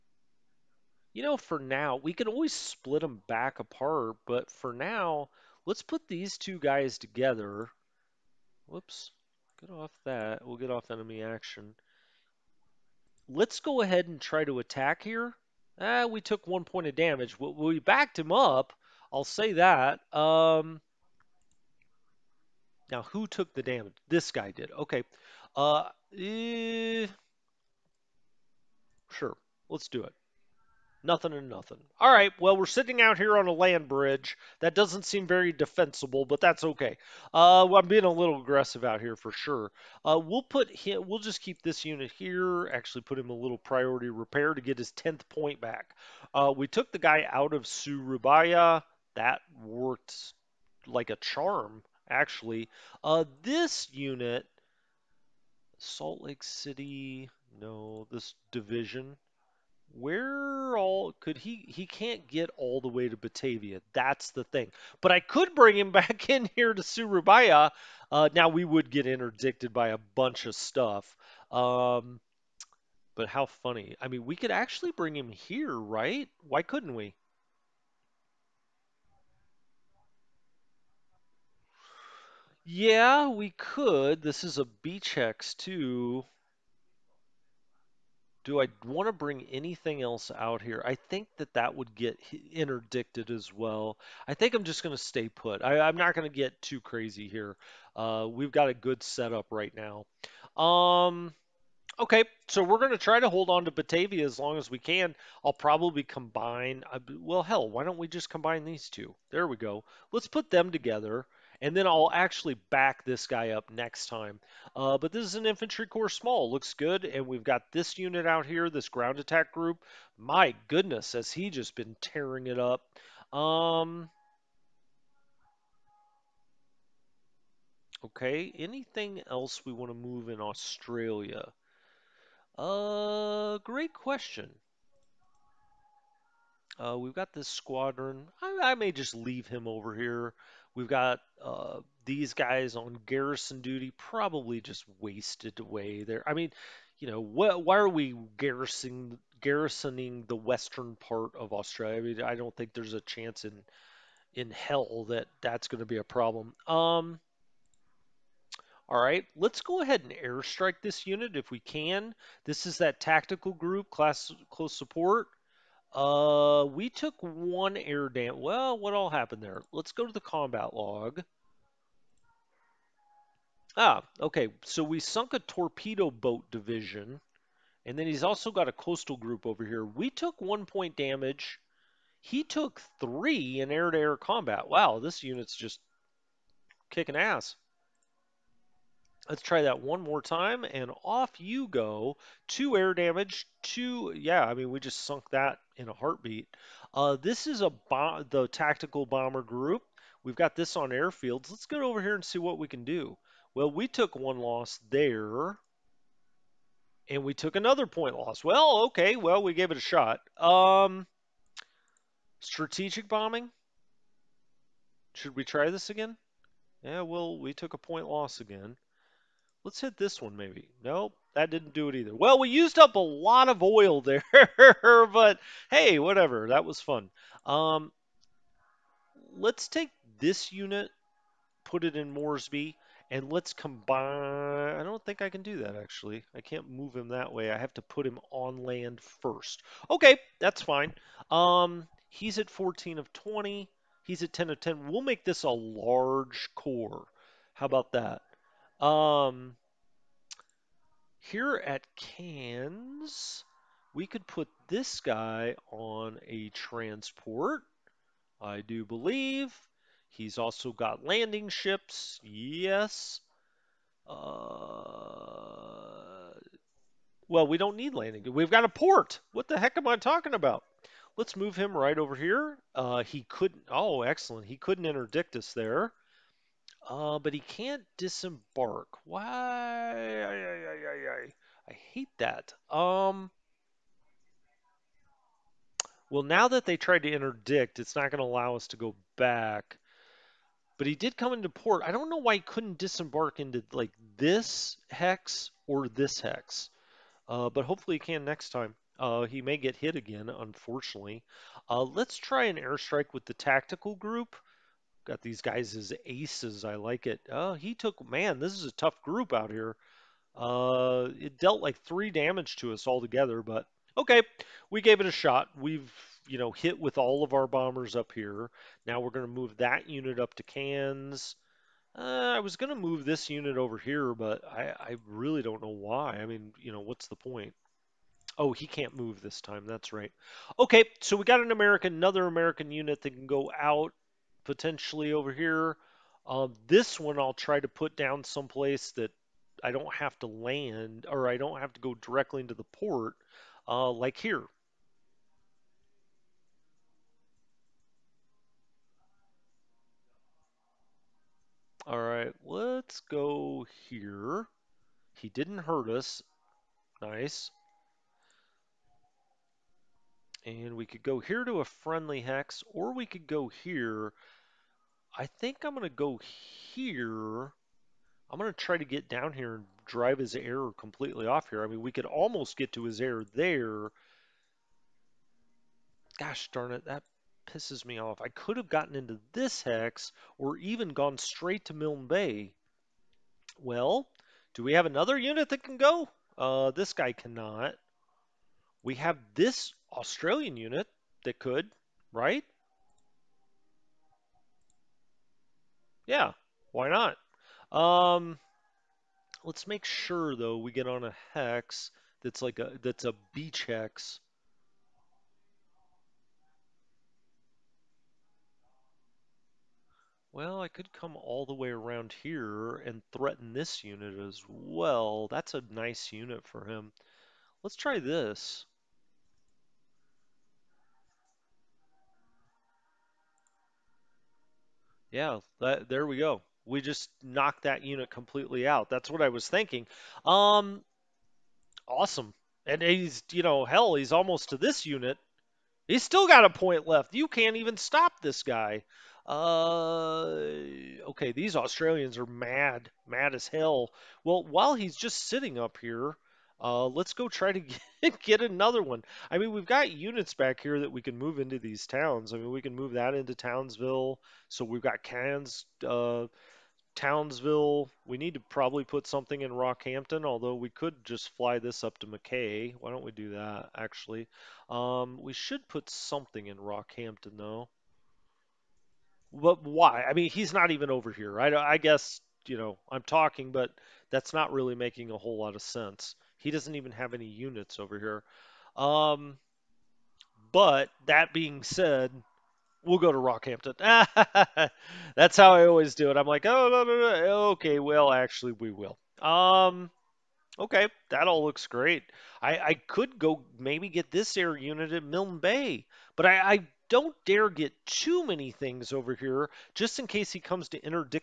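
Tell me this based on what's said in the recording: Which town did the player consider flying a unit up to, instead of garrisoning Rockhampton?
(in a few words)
Mackay.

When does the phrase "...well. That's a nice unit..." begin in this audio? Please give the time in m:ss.
6:54.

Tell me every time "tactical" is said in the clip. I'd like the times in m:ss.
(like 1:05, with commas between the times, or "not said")
2:43, 3:18, 5:03.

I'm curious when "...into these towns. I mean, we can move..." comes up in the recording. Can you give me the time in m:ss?
7:31.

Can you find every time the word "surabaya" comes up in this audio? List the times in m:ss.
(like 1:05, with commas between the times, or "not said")
0:47, 1:06.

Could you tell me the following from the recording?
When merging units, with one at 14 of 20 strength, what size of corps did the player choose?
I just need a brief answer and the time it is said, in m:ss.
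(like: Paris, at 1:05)
large corps, at 4:05.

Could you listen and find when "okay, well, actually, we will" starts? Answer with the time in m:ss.
8:07.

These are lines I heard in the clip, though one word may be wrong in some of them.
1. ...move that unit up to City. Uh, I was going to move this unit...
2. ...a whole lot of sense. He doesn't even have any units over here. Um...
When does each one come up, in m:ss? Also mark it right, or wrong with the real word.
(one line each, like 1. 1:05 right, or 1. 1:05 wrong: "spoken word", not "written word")
1. 5:19 wrong: "Cairns", not "City"
2. 7:55 right.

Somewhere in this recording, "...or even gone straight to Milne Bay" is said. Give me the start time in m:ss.
6:20.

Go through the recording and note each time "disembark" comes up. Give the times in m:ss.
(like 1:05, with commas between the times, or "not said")
4:37, 4:52.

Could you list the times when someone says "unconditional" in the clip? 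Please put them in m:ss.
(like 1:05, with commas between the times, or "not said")
not said.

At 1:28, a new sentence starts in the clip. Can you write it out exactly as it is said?
Do I want to bring anything else out here?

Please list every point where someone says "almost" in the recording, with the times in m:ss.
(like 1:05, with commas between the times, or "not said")
6:12, 7:14.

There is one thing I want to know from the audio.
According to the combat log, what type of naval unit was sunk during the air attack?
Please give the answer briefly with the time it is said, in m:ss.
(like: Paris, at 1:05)
torpedo boat division, at 2:55.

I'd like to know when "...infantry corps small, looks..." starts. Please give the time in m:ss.
1:55.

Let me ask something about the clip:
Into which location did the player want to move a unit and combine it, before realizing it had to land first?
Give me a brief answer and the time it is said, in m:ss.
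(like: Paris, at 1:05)
Moresby, at 3:52.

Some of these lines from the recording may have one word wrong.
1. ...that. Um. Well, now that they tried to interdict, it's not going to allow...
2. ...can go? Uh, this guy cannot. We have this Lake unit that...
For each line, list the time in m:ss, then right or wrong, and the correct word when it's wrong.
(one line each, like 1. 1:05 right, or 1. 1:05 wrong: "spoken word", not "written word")
1. 4:42 right
2. 6:25 wrong: "Australian", not "Lake".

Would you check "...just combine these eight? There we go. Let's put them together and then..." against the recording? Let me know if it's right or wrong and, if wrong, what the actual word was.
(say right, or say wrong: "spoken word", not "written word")
wrong: "two", not "eight".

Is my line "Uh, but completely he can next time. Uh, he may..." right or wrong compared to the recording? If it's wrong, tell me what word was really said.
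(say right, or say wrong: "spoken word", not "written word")
wrong: "hopefully", not "completely".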